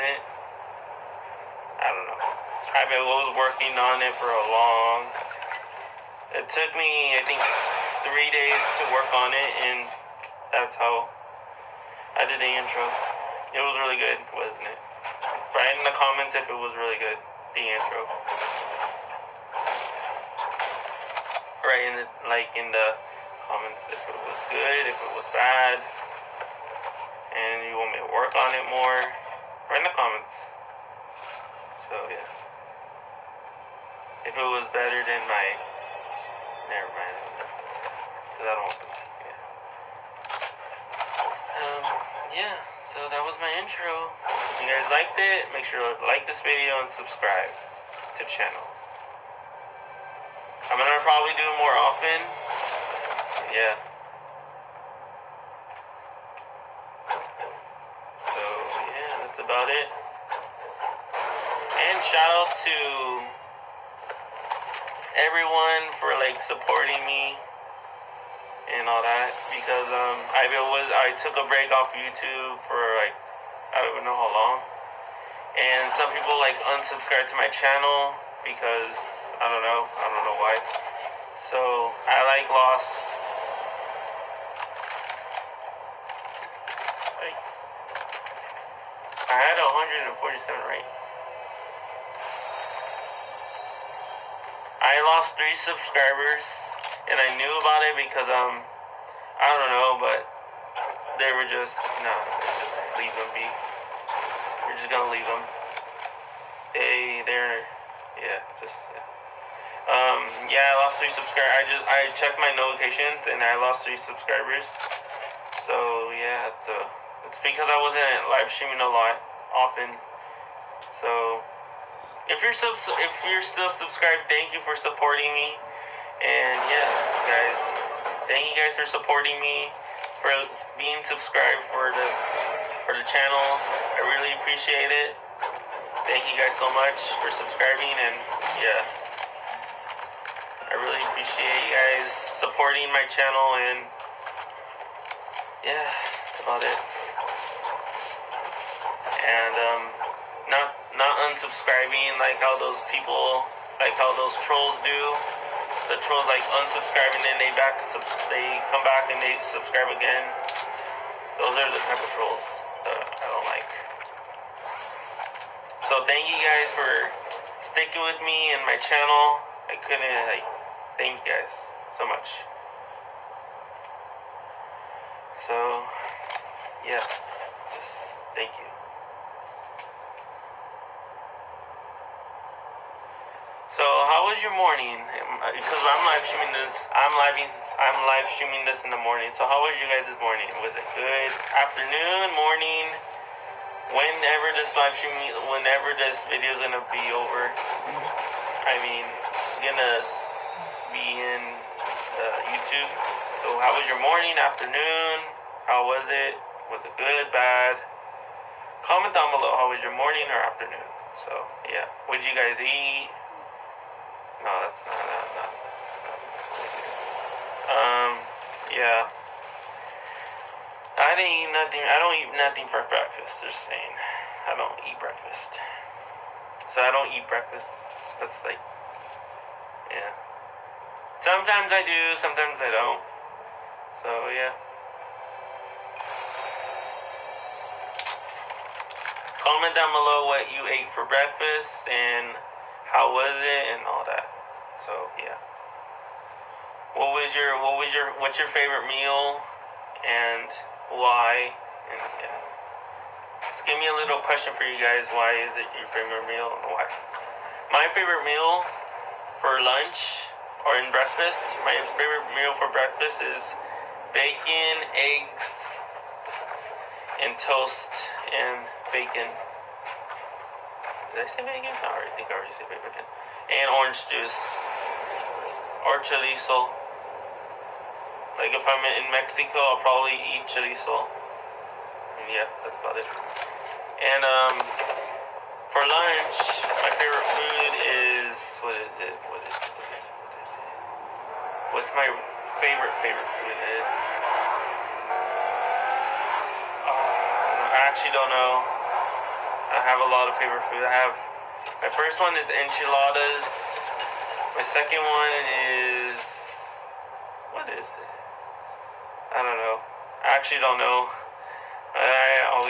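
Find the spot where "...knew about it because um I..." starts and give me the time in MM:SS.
01:37.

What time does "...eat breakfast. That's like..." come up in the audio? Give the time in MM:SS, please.
03:47.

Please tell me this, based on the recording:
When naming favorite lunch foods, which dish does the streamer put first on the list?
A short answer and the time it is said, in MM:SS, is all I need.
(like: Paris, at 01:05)
enchiladas, at 05:02.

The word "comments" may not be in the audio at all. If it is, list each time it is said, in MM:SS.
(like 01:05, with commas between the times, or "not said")
00:15, 00:23, 00:29, 03:28, 03:59.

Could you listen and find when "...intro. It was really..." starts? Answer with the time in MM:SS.
00:12.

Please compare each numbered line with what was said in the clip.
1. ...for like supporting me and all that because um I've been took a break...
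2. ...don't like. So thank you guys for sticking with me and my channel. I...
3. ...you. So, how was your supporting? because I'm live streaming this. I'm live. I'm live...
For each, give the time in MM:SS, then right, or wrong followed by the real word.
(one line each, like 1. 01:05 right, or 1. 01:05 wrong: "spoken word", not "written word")
1. 01:06 right
2. 02:43 right
3. 02:58 wrong: "morning", not "supporting".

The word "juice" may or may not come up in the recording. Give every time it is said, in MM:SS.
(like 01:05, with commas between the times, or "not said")
04:34.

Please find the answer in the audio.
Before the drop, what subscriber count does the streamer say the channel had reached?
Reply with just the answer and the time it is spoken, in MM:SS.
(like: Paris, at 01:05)
147, at 01:30.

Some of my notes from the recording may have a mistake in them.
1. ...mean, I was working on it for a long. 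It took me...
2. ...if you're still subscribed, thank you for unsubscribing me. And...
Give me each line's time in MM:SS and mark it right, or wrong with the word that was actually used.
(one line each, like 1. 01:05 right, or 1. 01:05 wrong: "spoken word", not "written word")
1. 00:02 right
2. 02:02 wrong: "supporting", not "unsubscribing".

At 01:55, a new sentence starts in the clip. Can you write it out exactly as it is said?
So, yeah, it's, a uh, it's because I wasn't live streaming a lot, often.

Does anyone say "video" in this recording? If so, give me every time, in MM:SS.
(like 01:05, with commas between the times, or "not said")
00:46, 03:16.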